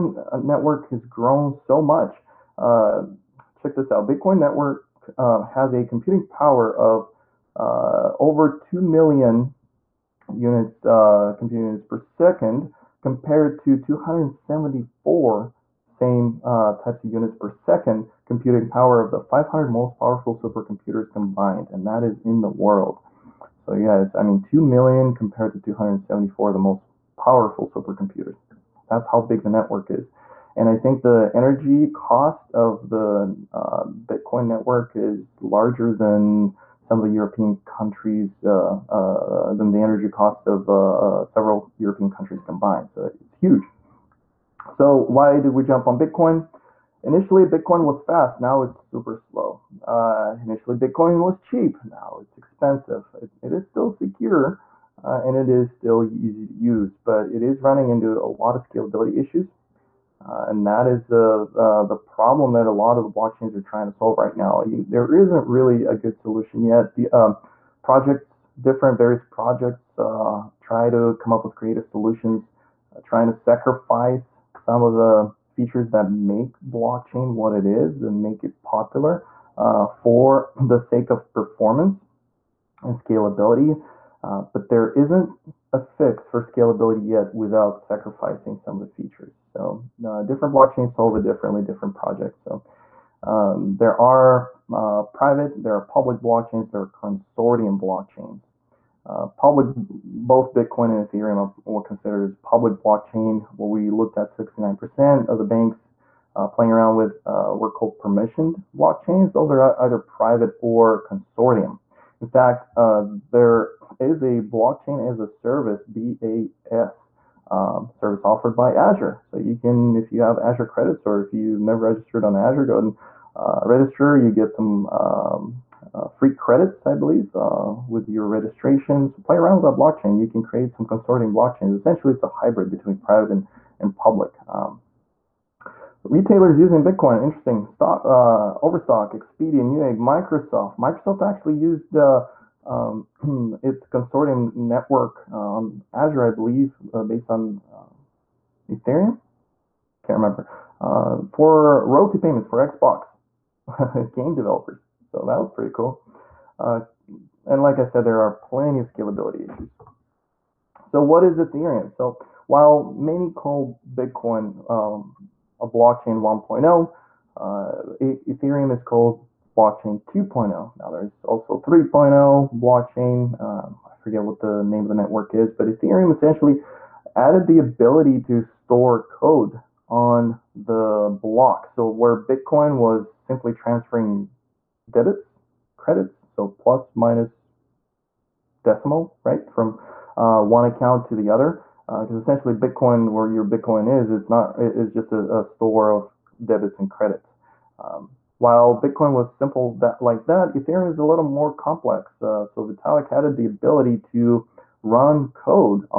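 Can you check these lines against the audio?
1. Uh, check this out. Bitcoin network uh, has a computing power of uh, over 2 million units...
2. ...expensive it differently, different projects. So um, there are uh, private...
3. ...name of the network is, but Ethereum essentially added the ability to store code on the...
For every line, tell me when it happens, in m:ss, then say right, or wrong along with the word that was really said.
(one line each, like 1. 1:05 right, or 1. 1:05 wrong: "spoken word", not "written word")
1. 0:02 right
2. 1:30 wrong: "solve", not "expensive"
3. 2:54 right.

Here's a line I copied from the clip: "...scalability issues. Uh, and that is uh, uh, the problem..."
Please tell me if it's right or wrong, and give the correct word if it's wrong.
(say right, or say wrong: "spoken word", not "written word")
right.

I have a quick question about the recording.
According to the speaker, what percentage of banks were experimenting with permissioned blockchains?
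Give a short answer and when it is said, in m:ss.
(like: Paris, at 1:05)
69%, at 1:44.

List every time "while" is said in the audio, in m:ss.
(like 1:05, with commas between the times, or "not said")
2:42, 3:18.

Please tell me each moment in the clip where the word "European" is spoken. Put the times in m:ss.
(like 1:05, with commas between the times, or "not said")
0:37, 0:41.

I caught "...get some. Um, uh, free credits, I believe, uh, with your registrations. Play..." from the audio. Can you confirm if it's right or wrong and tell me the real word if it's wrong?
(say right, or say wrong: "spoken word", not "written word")
right.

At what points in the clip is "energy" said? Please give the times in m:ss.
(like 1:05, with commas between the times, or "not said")
0:31, 0:39.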